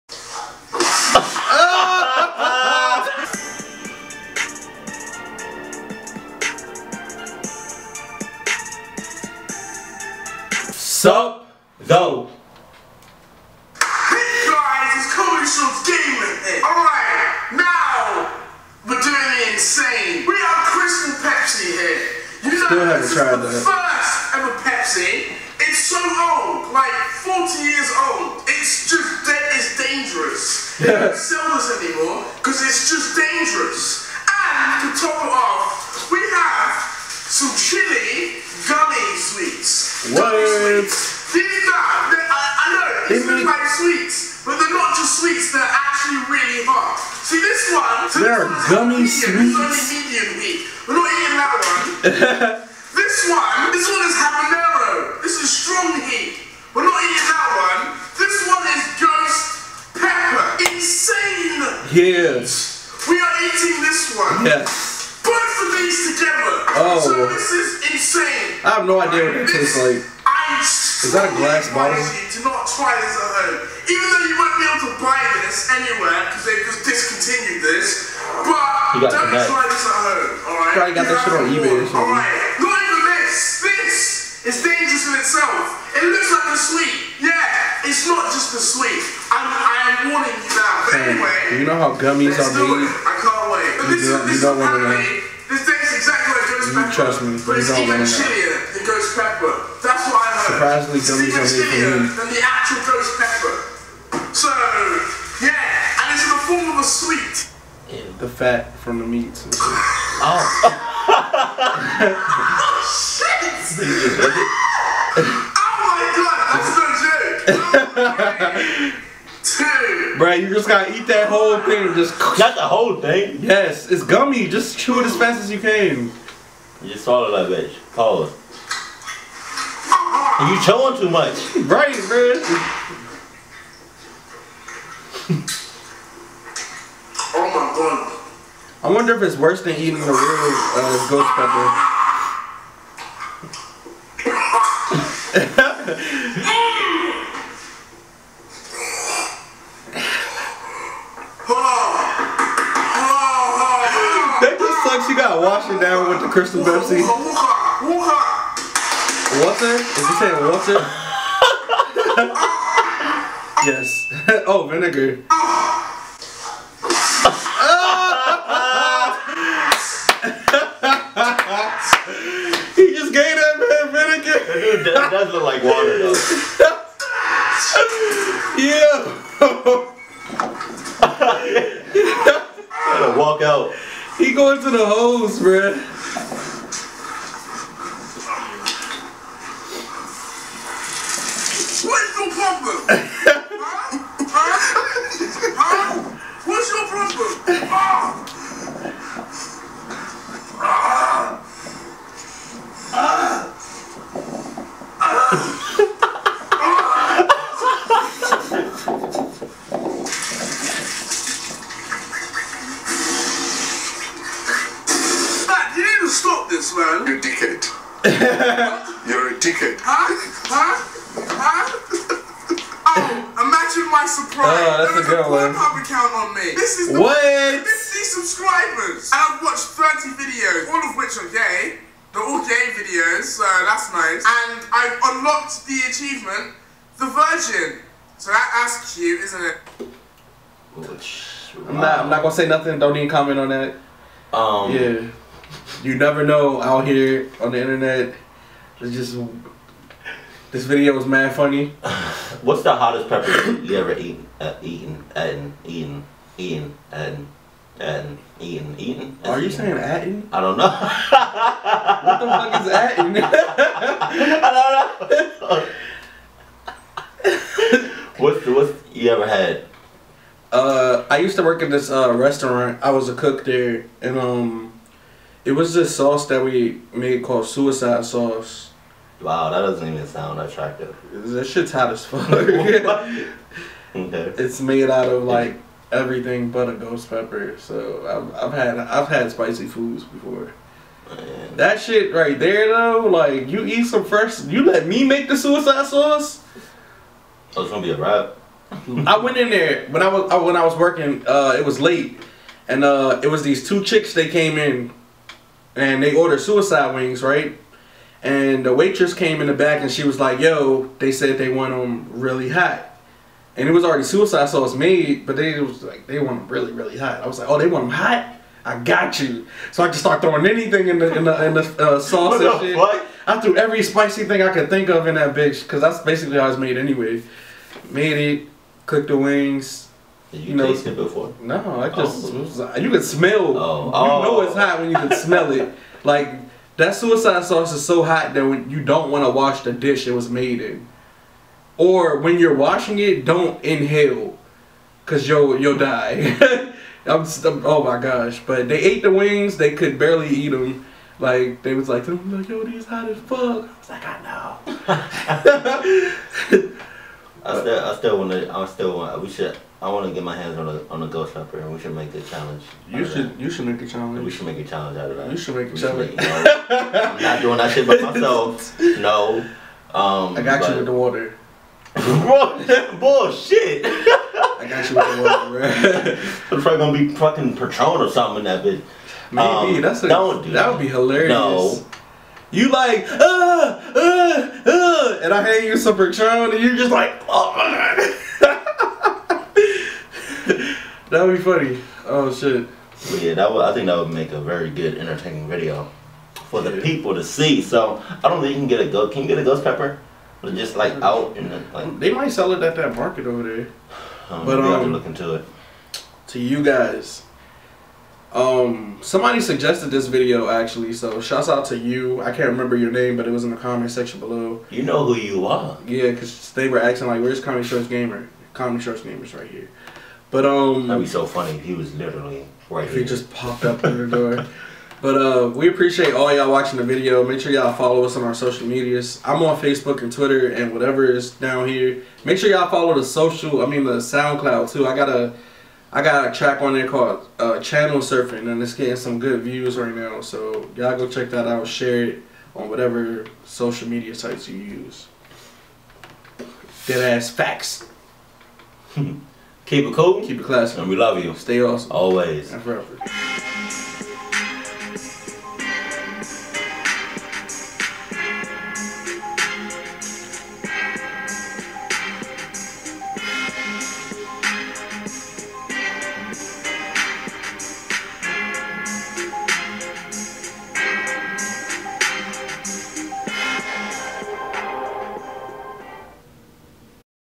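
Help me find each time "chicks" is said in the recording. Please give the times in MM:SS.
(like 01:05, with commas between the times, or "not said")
05:03.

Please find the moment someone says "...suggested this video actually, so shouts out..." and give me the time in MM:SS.
06:49.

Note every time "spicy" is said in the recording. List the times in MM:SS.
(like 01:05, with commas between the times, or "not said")
04:49, 05:23.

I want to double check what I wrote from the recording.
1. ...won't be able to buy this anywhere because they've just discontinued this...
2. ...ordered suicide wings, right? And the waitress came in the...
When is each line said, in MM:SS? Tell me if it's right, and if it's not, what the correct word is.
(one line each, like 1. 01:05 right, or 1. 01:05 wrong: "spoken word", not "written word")
1. 01:14 right
2. 05:06 right.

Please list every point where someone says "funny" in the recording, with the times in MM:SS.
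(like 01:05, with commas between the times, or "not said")
04:11, 06:31, 07:01.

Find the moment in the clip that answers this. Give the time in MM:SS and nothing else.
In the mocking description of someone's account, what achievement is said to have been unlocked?
03:56.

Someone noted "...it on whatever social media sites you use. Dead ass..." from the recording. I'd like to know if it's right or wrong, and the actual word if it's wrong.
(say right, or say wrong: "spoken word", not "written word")
right.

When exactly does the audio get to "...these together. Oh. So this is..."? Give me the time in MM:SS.
01:05.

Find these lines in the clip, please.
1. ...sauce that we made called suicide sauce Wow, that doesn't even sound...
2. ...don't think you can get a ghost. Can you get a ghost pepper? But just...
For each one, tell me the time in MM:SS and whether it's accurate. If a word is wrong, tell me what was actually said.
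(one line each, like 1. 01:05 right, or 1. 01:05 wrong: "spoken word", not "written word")
1. 04:35 right
2. 06:38 right.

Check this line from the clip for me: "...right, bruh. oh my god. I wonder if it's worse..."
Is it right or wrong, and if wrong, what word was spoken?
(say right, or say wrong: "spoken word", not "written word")
right.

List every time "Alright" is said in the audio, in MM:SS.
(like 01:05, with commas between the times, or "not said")
00:16, 01:22.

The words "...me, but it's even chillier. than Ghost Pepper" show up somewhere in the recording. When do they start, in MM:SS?
01:37.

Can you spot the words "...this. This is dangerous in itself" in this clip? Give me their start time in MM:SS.
01:23.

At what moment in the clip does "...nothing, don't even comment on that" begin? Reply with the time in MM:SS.
04:02.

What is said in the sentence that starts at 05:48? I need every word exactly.
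But they ate the wings, they could barely eat them.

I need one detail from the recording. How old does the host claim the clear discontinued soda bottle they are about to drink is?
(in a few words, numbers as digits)
40.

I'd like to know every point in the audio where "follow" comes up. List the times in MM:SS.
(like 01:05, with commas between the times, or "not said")
07:07, 07:12.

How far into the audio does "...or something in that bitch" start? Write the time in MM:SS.
06:18.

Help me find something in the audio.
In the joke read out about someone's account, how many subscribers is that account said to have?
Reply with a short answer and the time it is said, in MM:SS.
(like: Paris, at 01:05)
50, at 03:47.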